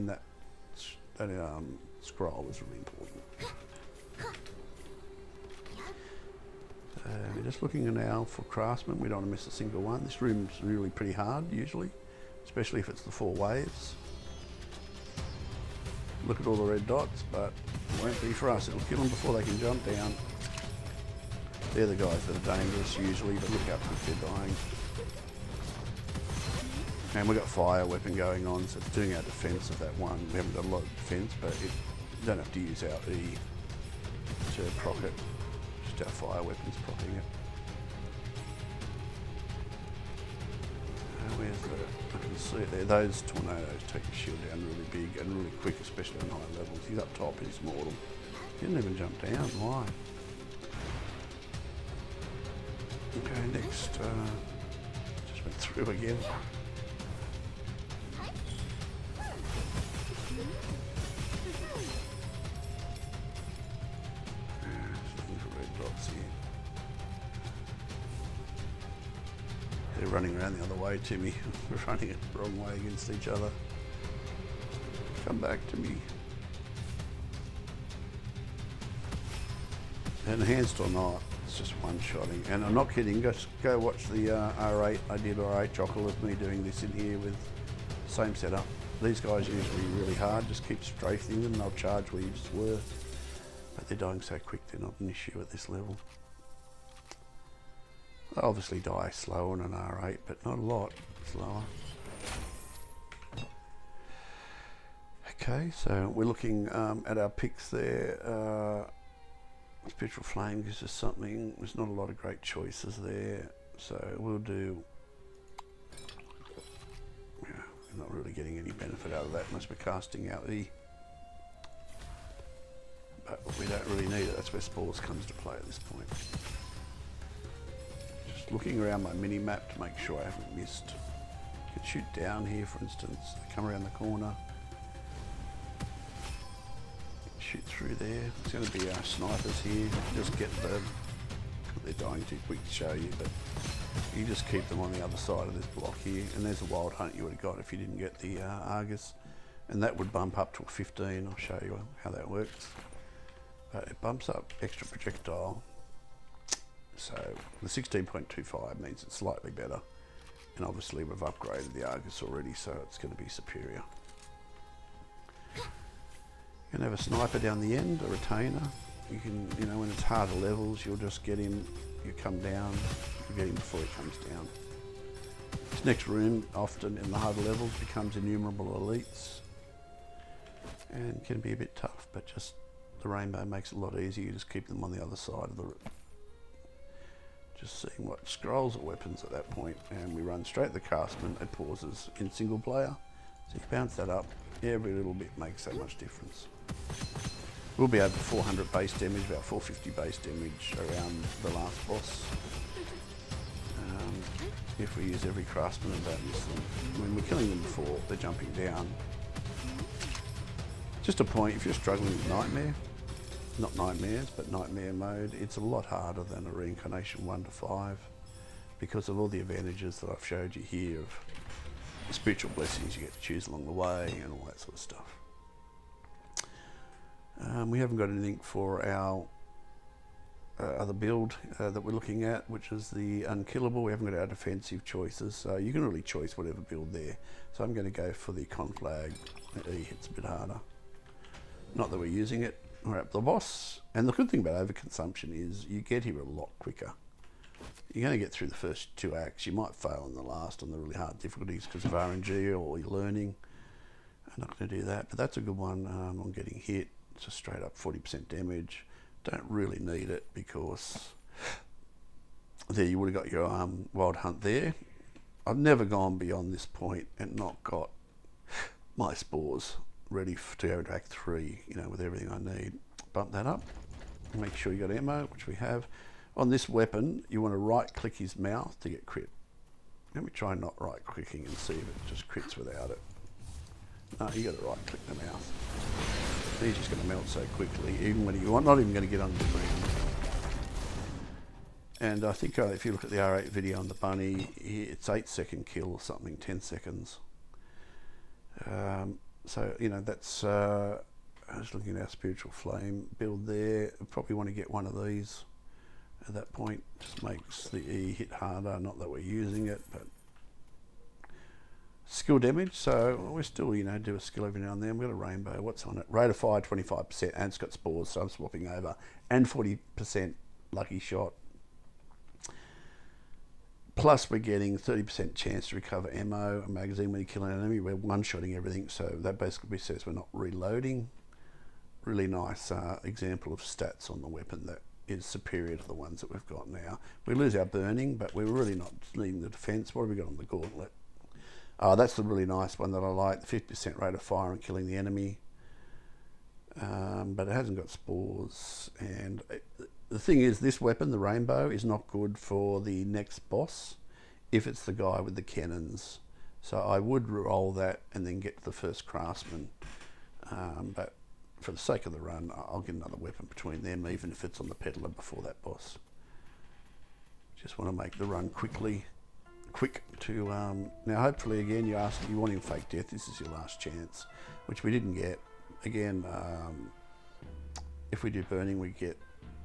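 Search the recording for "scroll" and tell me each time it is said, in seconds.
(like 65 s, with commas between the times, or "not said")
2 s, 188 s.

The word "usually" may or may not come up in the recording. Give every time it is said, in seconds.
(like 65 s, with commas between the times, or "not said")
11 s, 22 s.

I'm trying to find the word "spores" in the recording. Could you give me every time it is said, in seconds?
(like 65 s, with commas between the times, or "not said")
124 s, 269 s, 317 s, 347 s.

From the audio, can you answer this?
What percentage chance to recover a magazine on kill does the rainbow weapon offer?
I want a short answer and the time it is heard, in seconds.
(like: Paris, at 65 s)
30%, at 324 s.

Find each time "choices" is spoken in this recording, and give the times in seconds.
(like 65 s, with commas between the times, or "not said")
112 s, 234 s.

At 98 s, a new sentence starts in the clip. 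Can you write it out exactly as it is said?
They obviously die slow on an R8, but not a lot slower.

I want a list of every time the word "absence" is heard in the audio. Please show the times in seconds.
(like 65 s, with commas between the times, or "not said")
not said.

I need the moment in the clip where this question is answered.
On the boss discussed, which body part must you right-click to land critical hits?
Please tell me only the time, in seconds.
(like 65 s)
277 s.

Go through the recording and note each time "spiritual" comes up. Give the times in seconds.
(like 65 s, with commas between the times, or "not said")
109 s, 222 s, 302 s.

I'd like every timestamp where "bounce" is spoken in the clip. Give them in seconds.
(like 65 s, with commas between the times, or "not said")
193 s.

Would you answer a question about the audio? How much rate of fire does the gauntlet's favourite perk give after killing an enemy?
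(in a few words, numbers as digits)
50%.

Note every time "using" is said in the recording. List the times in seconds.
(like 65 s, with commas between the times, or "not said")
242 s, 309 s.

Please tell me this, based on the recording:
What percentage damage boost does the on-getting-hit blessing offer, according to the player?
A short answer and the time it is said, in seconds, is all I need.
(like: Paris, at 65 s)
40%, at 257 s.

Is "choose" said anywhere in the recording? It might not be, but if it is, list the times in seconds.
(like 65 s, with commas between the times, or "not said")
223 s, 236 s.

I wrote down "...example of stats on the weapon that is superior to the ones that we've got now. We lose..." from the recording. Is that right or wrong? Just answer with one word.
right.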